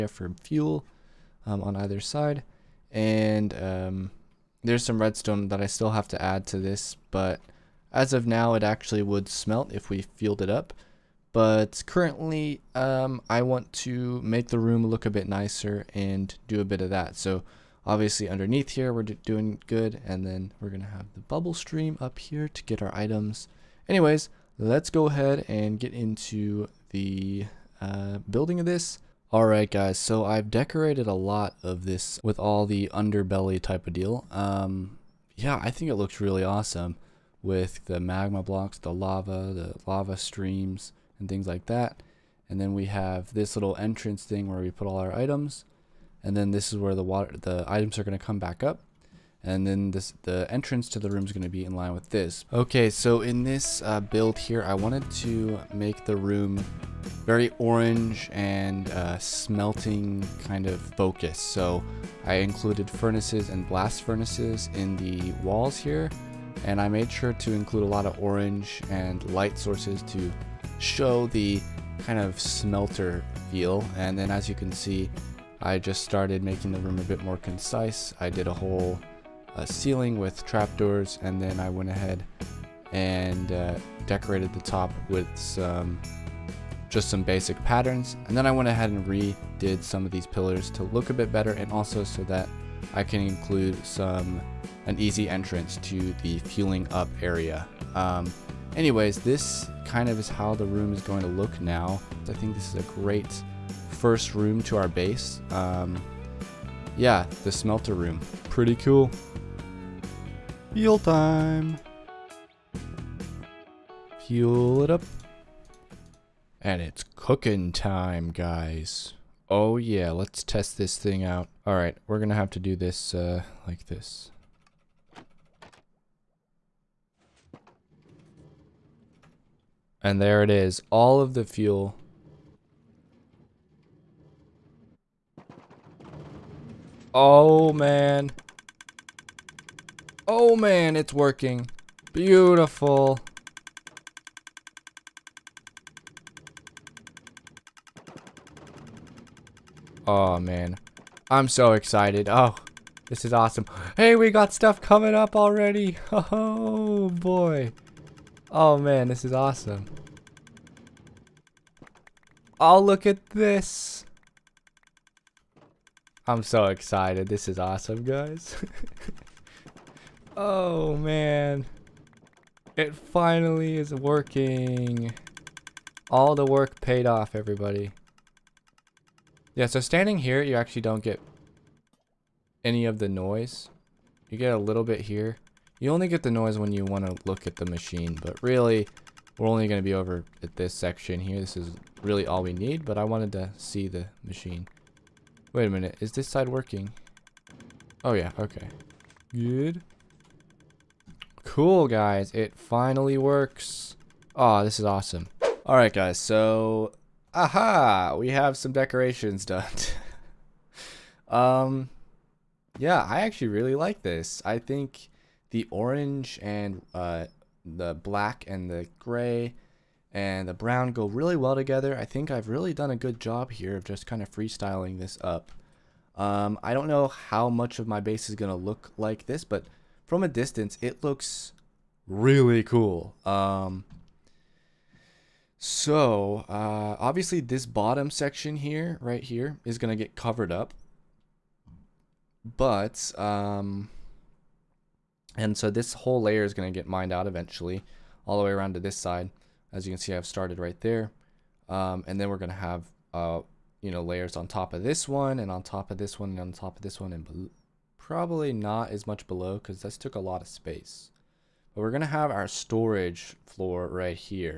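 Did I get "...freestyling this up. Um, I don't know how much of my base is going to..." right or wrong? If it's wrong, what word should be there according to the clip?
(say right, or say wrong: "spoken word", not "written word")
right.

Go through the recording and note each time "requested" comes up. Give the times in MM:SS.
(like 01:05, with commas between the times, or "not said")
not said.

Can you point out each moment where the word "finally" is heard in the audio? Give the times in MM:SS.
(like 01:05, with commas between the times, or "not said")
02:52, 03:22.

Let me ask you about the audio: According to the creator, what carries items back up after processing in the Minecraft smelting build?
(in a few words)
bubble stream.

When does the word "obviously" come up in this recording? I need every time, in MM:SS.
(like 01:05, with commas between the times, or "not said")
00:17, 03:56.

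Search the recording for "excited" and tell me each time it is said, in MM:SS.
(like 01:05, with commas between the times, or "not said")
02:31, 02:46.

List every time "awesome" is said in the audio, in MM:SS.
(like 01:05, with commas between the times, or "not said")
00:36, 02:33, 02:39, 02:47, 03:24.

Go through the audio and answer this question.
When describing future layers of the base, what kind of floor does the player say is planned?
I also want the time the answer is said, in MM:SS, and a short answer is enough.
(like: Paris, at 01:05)
storage floor, at 04:22.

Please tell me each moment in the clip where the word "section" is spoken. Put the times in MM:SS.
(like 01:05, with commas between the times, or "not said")
03:10, 03:58.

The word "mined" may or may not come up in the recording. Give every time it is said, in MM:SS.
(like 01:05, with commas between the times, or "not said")
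04:06.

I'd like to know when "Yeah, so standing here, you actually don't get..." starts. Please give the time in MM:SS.
02:59.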